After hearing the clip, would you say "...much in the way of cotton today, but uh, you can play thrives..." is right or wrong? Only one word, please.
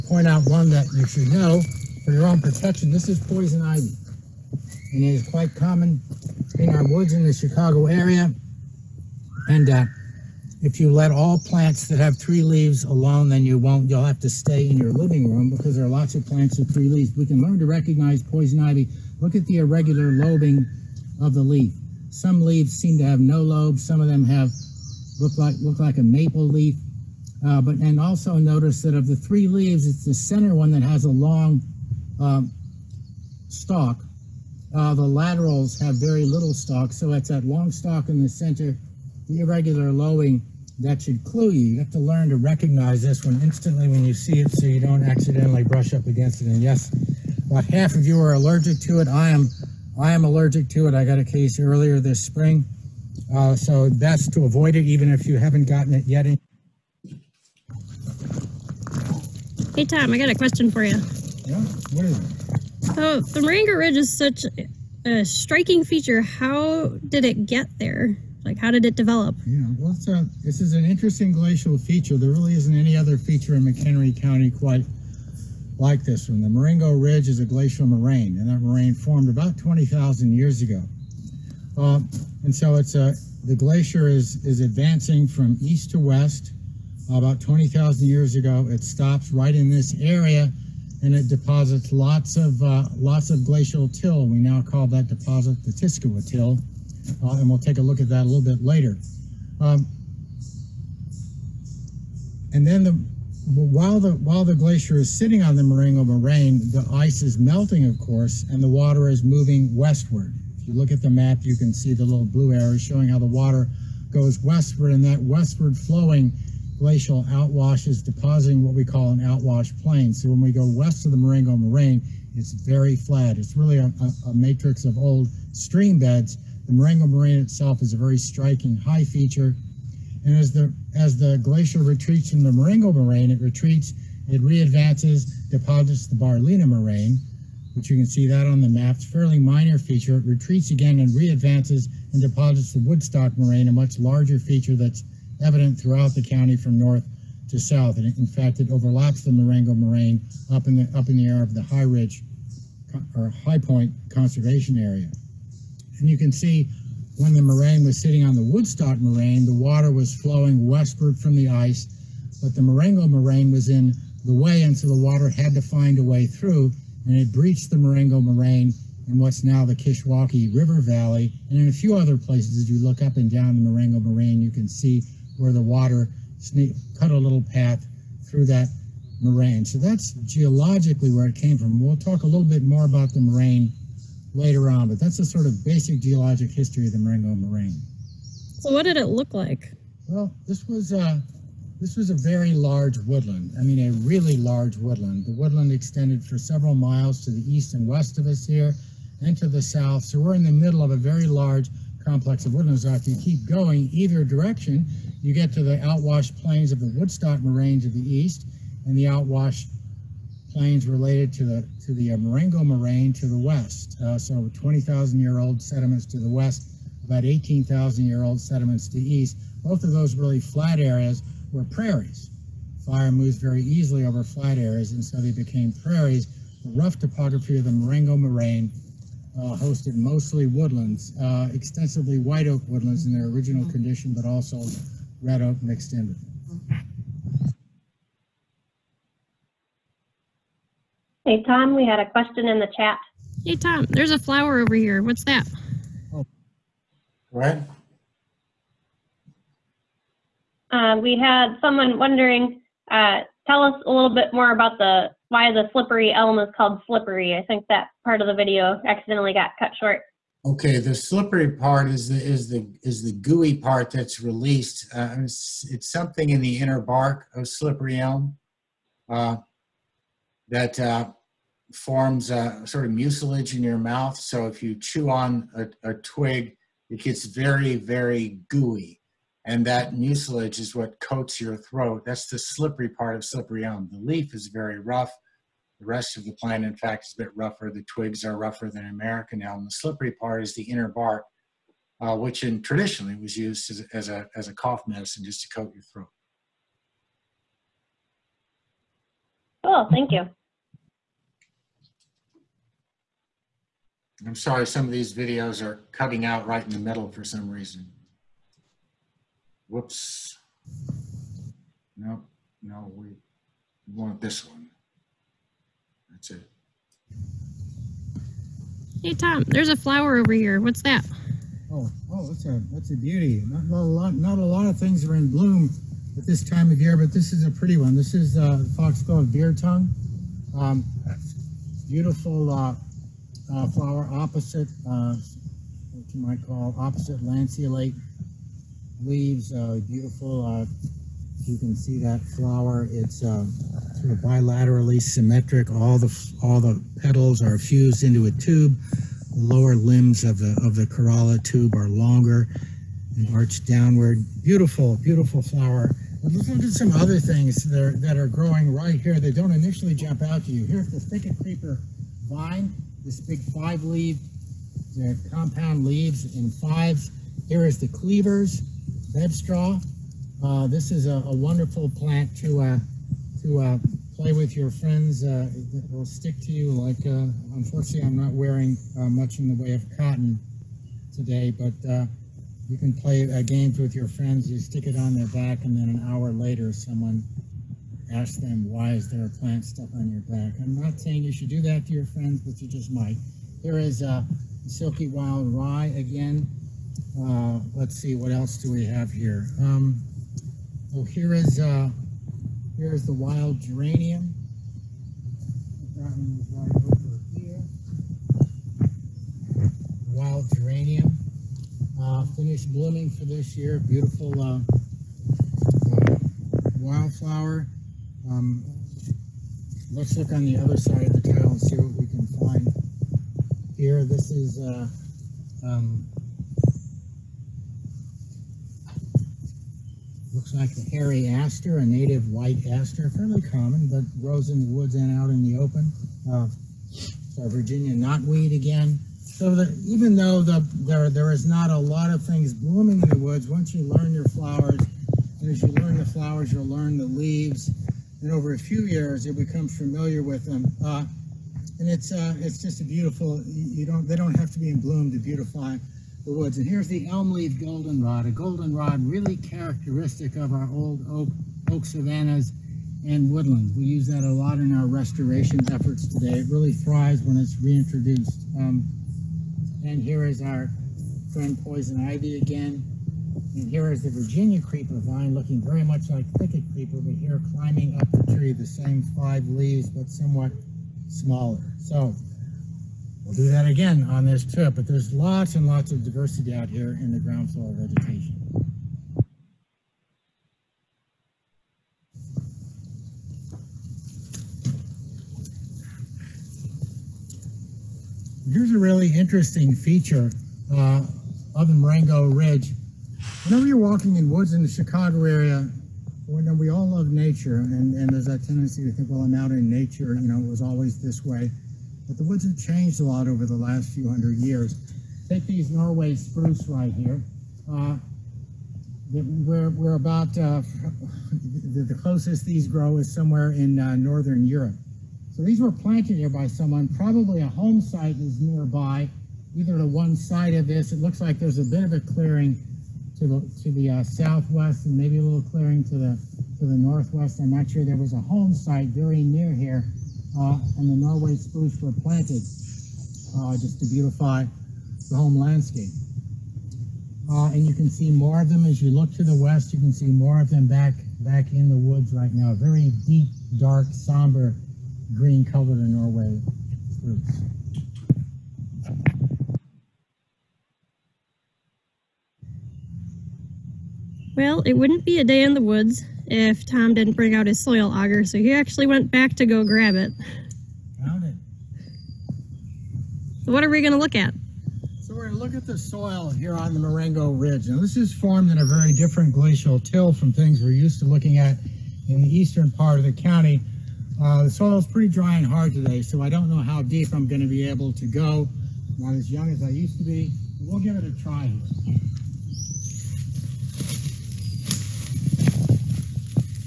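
wrong.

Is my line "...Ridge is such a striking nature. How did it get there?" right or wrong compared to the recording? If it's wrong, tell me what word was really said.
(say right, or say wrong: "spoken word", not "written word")
wrong: "feature", not "nature".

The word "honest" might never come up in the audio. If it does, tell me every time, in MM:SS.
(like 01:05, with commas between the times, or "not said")
not said.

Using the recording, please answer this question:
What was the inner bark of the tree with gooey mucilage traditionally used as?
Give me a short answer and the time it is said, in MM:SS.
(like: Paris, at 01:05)
cough medicine, at 04:54.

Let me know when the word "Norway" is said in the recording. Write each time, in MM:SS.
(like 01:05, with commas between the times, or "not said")
08:35, 09:00, 09:15.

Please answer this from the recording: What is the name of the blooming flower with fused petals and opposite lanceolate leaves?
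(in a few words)
foxglove beard tongue.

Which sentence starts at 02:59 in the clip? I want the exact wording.
So that's geologically where it came from.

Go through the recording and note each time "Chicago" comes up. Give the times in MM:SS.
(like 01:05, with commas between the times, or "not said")
00:07, 08:24.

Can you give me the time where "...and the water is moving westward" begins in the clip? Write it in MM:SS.
01:48.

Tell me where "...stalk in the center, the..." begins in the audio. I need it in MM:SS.
00:37.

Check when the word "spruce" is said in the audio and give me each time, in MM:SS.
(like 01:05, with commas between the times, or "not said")
08:36, 09:01, 09:16.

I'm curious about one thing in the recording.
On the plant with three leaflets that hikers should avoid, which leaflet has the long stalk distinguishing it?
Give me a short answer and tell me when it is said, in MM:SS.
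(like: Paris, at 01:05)
the center one, at 00:30.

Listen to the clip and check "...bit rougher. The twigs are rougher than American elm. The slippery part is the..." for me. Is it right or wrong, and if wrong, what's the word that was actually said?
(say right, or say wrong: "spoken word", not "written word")
right.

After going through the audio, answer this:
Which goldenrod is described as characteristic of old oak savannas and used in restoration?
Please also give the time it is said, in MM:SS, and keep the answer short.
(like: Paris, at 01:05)
elm leaf goldenrod, at 07:37.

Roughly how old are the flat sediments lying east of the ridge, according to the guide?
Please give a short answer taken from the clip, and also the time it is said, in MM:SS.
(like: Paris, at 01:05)
18,000 years, at 03:37.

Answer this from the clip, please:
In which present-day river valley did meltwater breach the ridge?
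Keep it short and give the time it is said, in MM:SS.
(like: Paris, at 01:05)
Kishwaukee River Valley, at 02:49.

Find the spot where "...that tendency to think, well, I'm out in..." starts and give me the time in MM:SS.
08:28.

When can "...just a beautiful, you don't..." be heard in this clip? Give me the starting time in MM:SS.
07:32.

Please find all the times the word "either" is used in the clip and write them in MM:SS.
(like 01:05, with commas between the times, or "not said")
03:23, 08:49.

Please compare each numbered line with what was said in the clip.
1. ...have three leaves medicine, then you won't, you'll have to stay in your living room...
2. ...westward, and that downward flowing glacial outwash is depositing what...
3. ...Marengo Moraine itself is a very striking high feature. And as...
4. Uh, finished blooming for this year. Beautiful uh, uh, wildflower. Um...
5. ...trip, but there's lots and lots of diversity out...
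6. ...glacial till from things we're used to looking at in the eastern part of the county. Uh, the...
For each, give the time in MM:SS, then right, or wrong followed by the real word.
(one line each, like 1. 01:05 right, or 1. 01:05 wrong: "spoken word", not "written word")
1. 00:11 wrong: "alone", not "medicine"
2. 01:54 wrong: "westward", not "downward"
3. 02:06 right
4. 06:51 right
5. 08:04 right
6. 09:39 right.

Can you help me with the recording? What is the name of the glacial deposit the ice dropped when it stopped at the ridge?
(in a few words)
Tiskilwa till.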